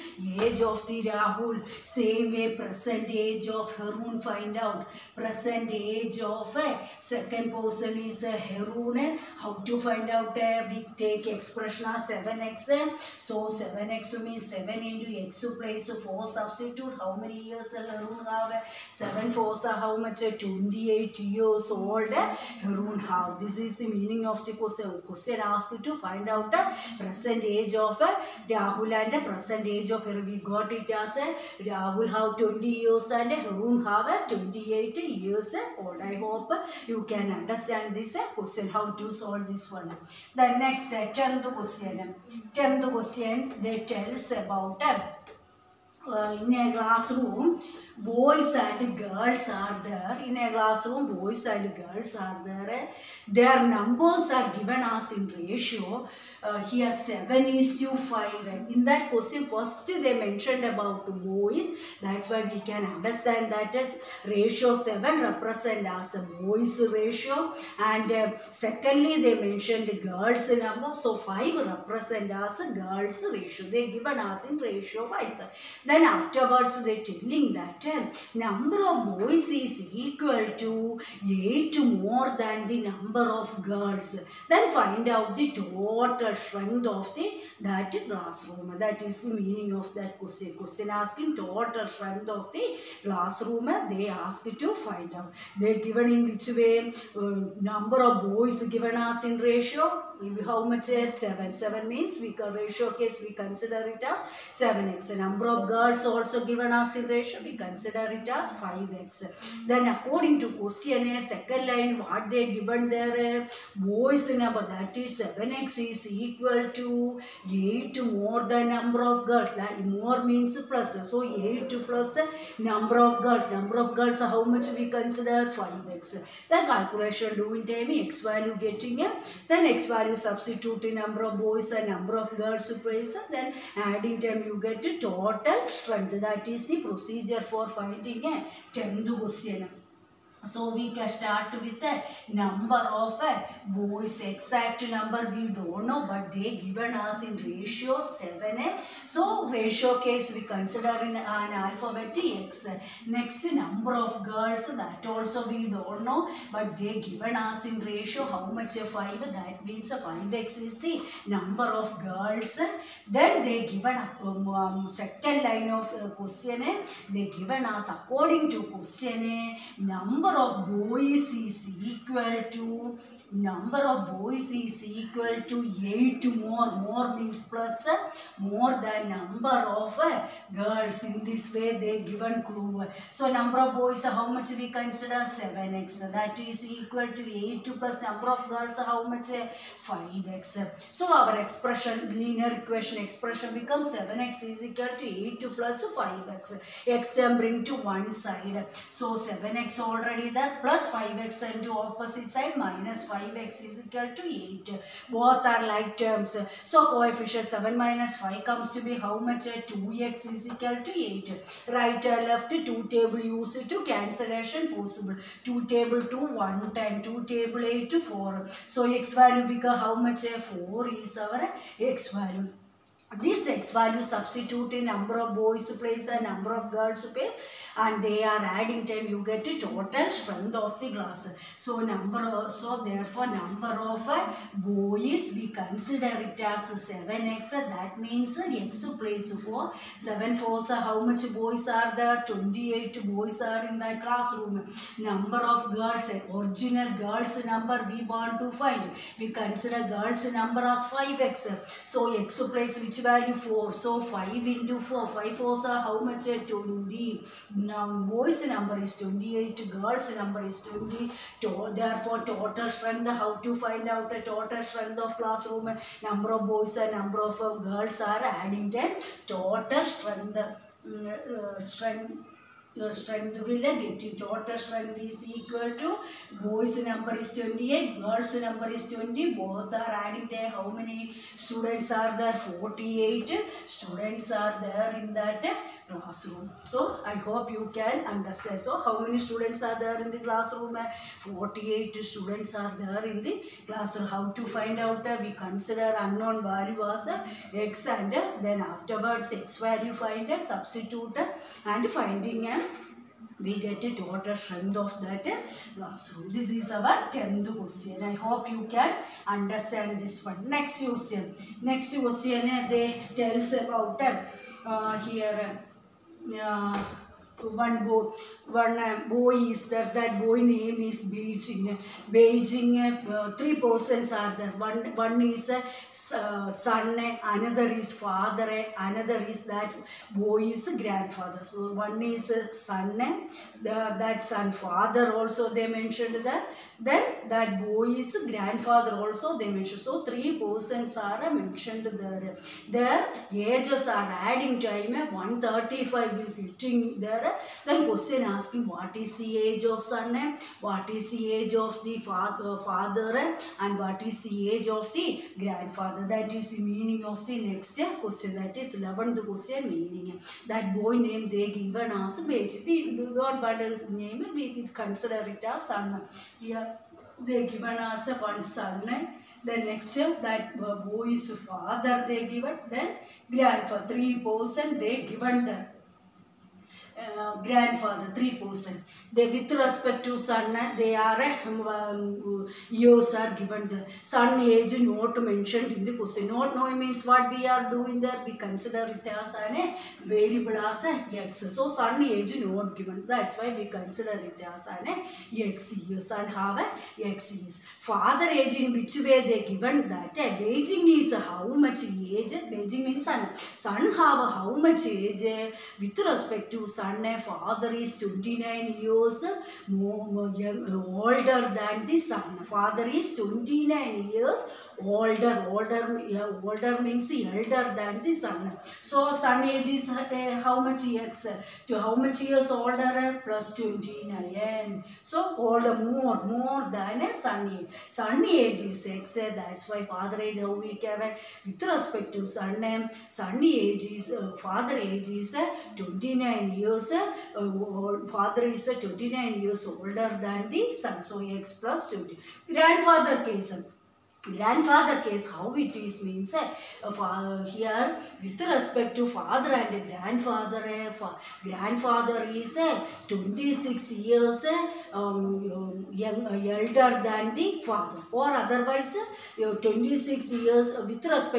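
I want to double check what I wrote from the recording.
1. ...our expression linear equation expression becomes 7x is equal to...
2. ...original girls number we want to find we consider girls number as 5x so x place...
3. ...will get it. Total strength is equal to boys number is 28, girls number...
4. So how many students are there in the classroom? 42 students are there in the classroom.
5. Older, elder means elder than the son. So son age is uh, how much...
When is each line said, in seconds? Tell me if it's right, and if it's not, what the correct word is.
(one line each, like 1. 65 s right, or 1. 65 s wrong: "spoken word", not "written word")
1. 191 s right
2. 246 s right
3. 273 s right
4. 288 s wrong: "48", not "42"
5. 414 s wrong: "older", not "elder".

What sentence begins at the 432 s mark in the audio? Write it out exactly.
Uh, son age is father age is 29 years.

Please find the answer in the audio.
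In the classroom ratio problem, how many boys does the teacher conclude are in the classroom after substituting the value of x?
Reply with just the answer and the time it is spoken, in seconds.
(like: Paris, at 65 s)
28, at 242 s.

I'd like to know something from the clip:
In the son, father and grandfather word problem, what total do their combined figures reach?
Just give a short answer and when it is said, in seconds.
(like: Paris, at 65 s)
135, at 345 s.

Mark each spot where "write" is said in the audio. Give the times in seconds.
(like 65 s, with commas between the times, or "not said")
not said.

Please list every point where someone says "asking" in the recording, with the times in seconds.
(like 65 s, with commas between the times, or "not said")
90 s, 348 s.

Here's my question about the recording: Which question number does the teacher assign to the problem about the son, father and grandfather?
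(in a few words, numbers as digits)
11th.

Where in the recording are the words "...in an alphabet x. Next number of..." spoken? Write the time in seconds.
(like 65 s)
151 s.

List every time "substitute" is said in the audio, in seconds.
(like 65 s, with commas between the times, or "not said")
16 s, 130 s, 224 s, 300 s.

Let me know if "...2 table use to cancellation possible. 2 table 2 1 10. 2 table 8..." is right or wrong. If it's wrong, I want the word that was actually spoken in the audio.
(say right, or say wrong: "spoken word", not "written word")
right.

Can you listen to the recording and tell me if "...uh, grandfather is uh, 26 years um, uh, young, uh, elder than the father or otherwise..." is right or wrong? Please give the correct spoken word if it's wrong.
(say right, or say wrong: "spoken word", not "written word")
right.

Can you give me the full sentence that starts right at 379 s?
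They, with respect to sun, they are um, years are given.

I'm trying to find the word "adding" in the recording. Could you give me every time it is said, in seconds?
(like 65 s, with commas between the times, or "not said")
133 s, 228 s, 268 s, 280 s, 344 s.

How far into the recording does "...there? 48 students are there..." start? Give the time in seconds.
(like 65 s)
282 s.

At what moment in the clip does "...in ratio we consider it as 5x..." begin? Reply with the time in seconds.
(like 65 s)
106 s.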